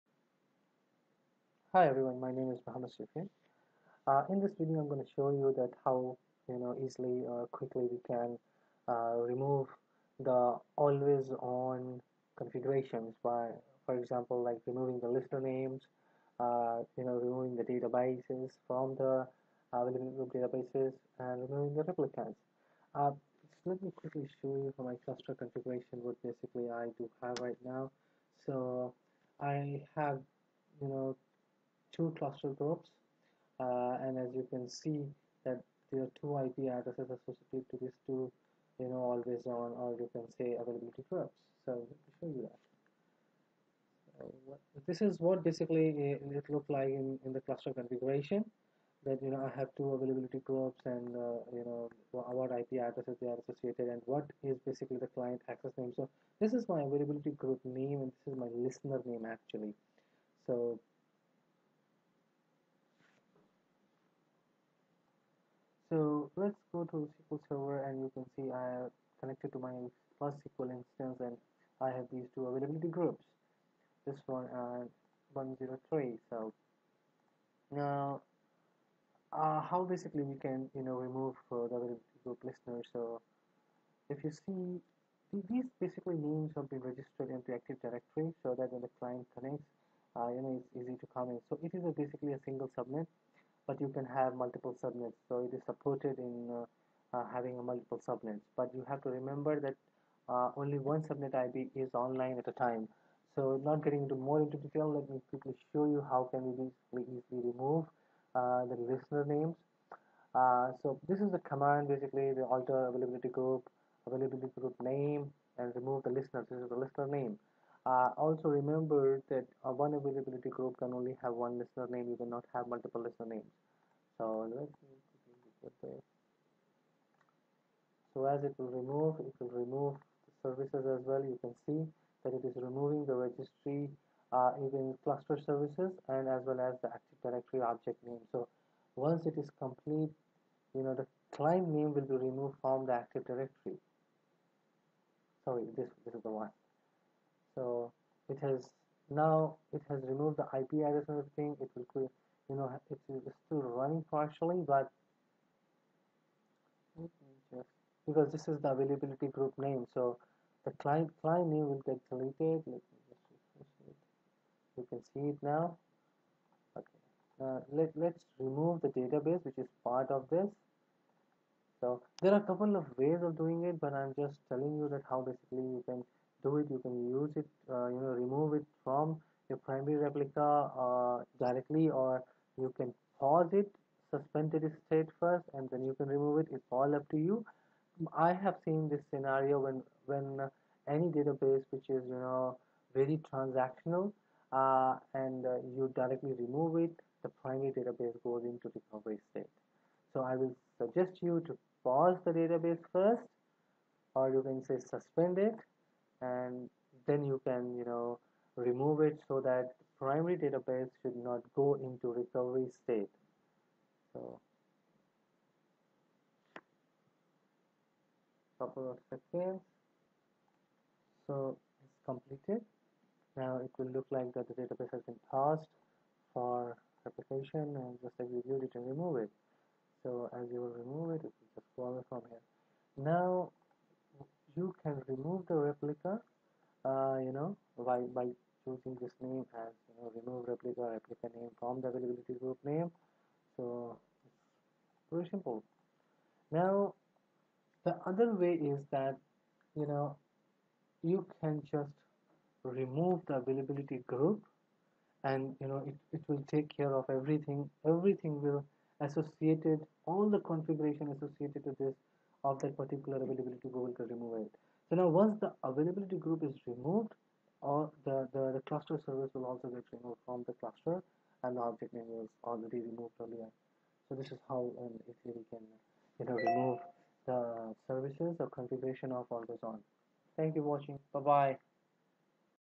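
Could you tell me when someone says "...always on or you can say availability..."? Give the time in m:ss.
0:39.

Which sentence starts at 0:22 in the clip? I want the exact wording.
Uh, let me quickly show you for my cluster configuration what basically I do have right now.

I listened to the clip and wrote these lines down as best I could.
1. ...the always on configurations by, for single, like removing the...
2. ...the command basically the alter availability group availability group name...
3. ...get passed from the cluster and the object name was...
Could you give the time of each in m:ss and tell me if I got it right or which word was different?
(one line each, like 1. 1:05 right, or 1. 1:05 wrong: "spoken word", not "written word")
1. 0:10 wrong: "example", not "single"
2. 1:51 right
3. 4:29 wrong: "removed", not "passed".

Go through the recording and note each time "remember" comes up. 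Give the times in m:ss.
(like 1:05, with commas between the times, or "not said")
1:39, 1:58.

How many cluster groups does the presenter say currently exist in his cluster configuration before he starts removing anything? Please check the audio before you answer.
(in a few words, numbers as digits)
2.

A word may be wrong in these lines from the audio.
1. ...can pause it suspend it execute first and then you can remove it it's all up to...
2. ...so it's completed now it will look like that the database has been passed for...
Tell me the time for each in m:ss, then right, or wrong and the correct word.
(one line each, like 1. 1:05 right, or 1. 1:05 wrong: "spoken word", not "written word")
1. 3:02 wrong: "state", not "execute"
2. 3:41 right.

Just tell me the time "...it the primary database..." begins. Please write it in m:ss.
3:16.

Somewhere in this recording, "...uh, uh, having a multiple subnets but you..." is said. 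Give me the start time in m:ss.
1:36.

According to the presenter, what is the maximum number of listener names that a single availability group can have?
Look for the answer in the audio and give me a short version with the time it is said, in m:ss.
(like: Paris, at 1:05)
1, at 2:01.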